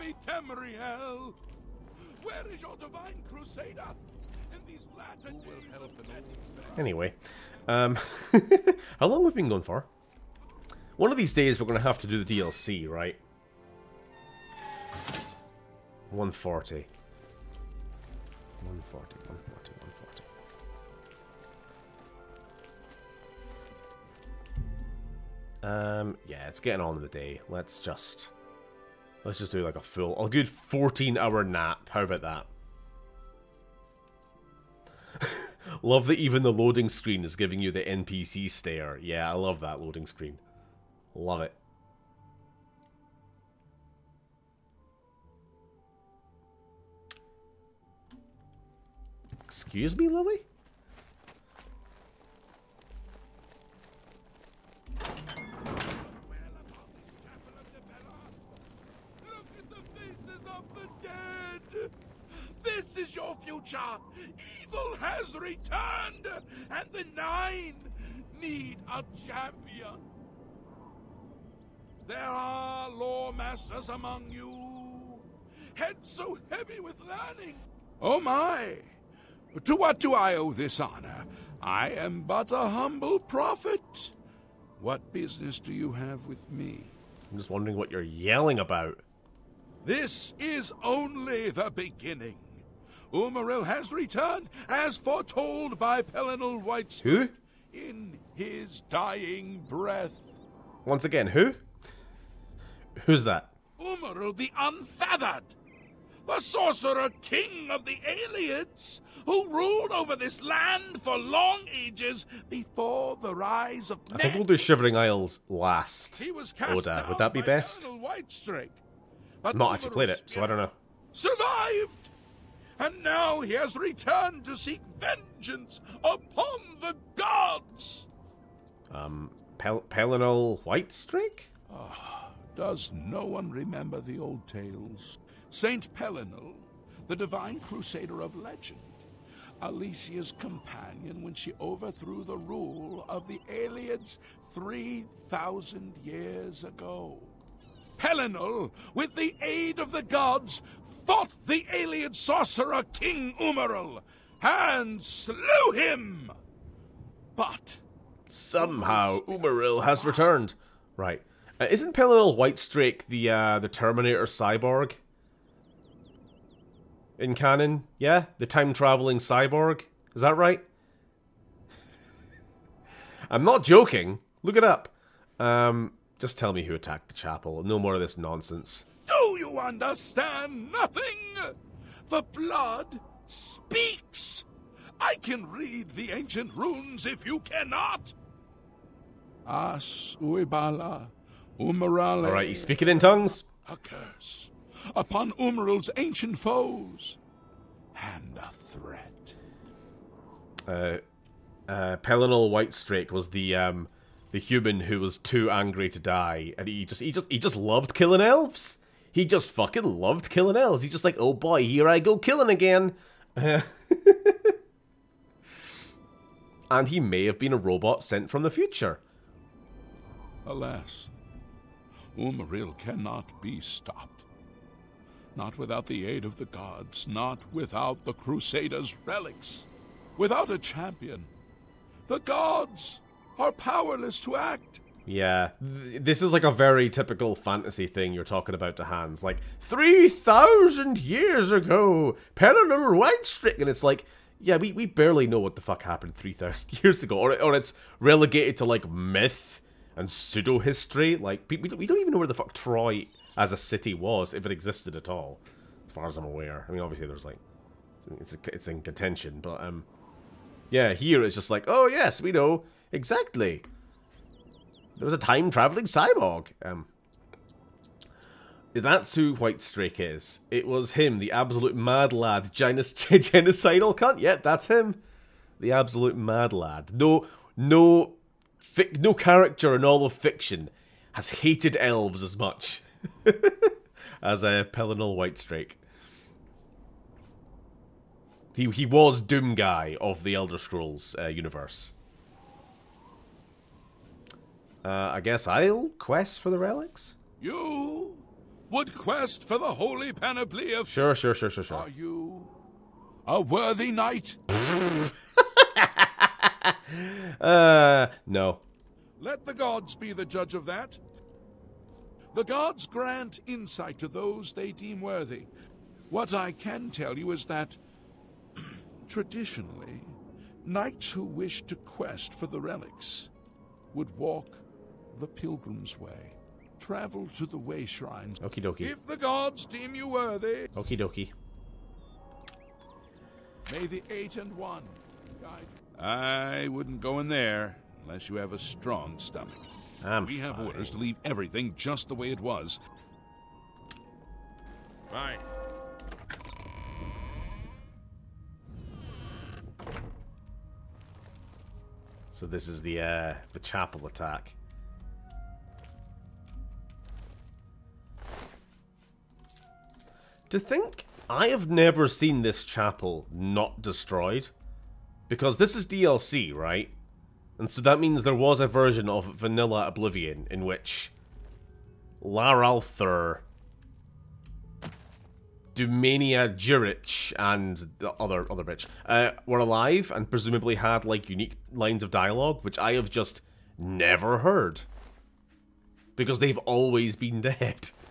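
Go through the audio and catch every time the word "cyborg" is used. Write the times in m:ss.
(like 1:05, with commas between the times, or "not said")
2:44, 2:49, 4:25.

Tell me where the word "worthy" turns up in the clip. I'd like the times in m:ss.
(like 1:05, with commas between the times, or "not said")
5:03, 5:14, 5:30.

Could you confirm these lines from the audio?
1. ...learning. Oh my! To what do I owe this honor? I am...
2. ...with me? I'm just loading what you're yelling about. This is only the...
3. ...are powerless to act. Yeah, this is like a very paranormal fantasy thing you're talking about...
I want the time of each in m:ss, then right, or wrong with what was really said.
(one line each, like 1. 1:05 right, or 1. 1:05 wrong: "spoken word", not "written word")
1. 1:17 right
2. 1:26 wrong: "wondering", not "loading"
3. 3:53 wrong: "typical", not "paranormal".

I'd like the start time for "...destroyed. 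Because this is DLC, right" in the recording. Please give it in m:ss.
6:03.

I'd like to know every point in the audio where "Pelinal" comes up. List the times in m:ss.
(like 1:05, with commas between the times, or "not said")
1:36, 2:09, 2:15, 2:27, 2:41, 3:21, 4:44.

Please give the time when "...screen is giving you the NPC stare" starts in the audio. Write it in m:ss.
0:36.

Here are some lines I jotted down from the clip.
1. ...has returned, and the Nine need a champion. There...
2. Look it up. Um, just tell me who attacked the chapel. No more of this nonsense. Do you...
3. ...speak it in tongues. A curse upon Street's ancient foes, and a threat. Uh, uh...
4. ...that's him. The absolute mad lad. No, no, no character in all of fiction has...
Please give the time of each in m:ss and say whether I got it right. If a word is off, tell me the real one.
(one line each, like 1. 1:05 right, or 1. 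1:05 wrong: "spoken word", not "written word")
1. 1:04 right
2. 2:54 right
3. 3:12 wrong: "Umaril", not "Street"
4. 4:34 right.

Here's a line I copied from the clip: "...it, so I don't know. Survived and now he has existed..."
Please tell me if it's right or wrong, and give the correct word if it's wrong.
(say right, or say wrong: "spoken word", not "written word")
wrong: "returned", not "existed".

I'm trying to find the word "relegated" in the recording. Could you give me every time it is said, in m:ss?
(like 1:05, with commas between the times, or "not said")
4:07.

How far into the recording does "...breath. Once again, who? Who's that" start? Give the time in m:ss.
1:39.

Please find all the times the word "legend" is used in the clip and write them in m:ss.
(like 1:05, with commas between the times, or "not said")
2:18.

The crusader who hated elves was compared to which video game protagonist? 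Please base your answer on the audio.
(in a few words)
Doom Guy.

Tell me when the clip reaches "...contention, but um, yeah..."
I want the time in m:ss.
4:18.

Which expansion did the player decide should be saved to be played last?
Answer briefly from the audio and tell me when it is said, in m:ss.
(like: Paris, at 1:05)
Shivering Isles, at 1:54.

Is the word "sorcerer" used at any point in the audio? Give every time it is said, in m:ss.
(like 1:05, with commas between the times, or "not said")
1:46, 2:32.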